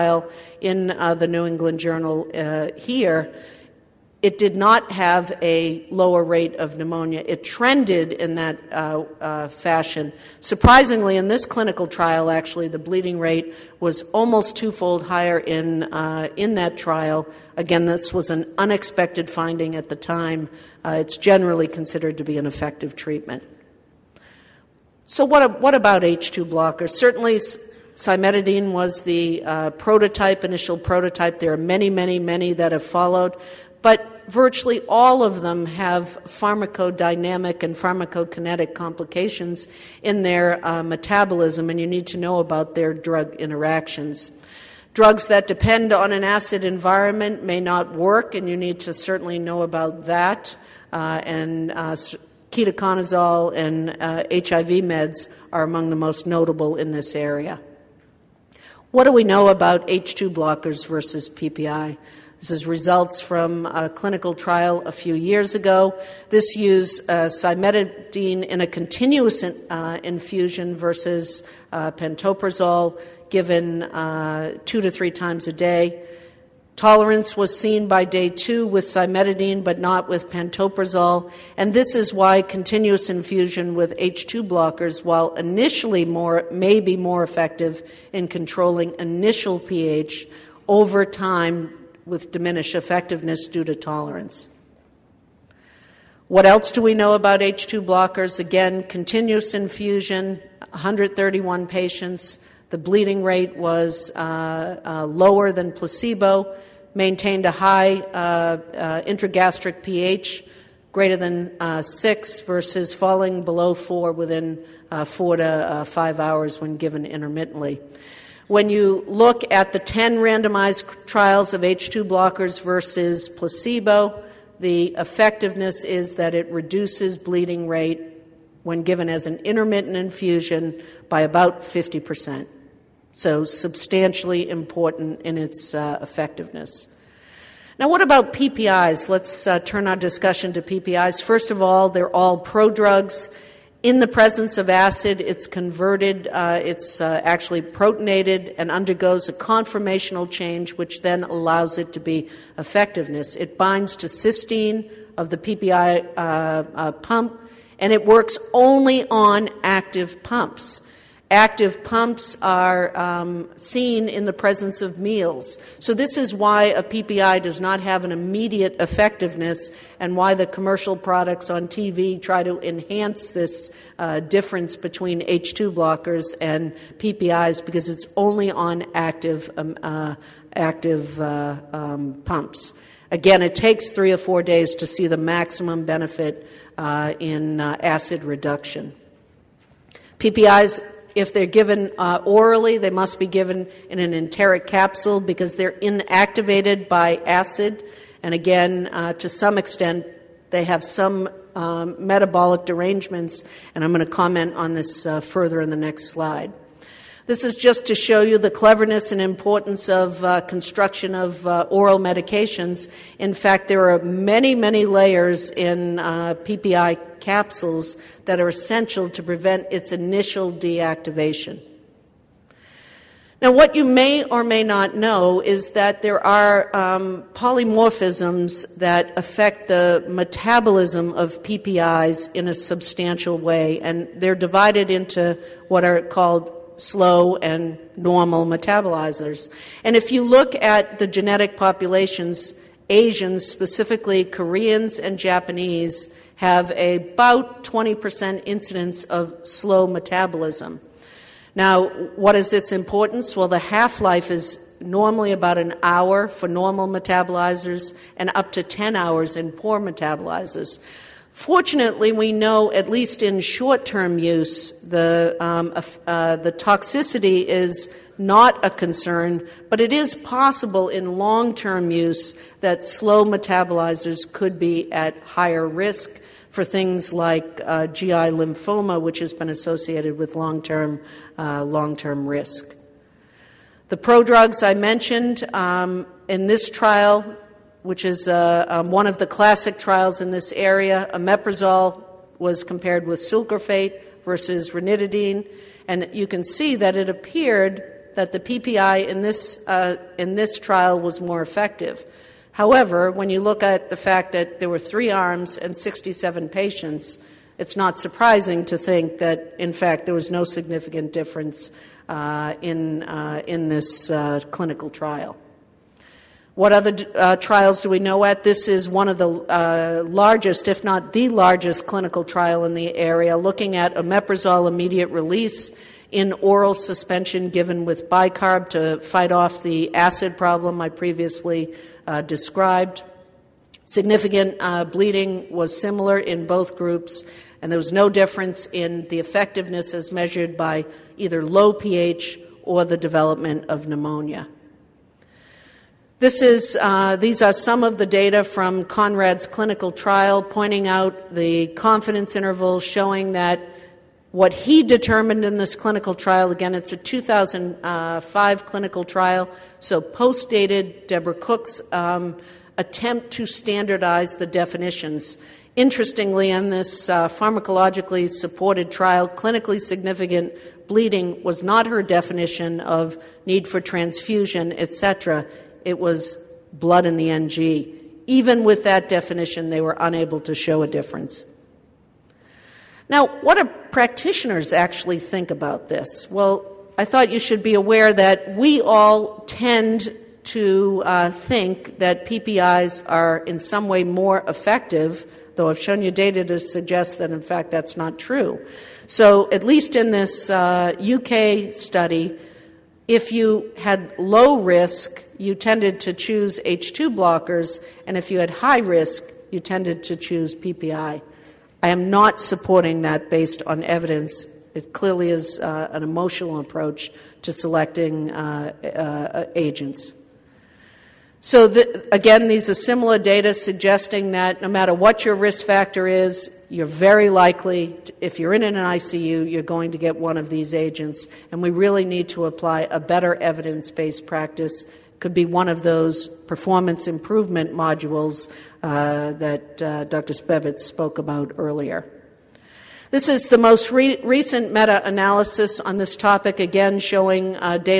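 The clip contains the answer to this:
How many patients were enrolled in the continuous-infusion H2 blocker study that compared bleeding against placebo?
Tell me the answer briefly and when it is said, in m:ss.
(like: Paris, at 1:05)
131, at 1:40.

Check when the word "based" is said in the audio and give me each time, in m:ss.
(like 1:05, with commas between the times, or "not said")
6:53, 7:13.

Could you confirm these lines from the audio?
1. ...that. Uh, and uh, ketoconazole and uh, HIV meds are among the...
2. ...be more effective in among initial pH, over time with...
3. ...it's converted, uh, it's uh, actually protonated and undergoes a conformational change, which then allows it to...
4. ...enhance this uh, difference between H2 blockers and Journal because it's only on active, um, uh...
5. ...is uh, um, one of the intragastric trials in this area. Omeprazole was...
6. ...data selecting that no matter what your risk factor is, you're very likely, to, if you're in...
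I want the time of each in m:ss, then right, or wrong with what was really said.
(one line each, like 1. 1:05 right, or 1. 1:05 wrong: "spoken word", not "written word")
1. 0:50 right
2. 1:26 wrong: "controlling", not "among"
3. 2:25 right
4. 2:52 wrong: "PPIs", not "Journal"
5. 4:48 wrong: "classic", not "intragastric"
6. 7:03 wrong: "suggesting", not "selecting".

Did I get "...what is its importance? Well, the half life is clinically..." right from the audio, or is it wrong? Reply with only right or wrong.
wrong.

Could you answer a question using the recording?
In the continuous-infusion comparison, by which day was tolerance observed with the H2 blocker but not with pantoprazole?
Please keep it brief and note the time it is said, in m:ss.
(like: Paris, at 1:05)
day 2, at 1:18.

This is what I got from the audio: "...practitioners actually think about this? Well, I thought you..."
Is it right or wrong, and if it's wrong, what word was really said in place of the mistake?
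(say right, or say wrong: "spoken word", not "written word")
right.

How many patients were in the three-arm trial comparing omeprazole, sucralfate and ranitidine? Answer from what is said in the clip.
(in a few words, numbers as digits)
67.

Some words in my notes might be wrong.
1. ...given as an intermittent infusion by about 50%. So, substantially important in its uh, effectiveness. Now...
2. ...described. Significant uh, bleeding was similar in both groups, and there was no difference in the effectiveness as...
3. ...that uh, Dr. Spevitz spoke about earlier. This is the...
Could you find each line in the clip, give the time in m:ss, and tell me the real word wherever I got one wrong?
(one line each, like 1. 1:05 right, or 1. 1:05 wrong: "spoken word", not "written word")
1. 2:08 right
2. 5:32 right
3. 7:19 right.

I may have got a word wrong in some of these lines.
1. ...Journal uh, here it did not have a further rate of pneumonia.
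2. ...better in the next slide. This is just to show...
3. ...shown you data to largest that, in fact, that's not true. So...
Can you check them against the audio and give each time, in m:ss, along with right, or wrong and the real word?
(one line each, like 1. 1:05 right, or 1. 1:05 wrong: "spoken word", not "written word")
1. 0:01 wrong: "lower", not "further"
2. 3:25 wrong: "further", not "better"
3. 6:35 wrong: "suggest", not "largest".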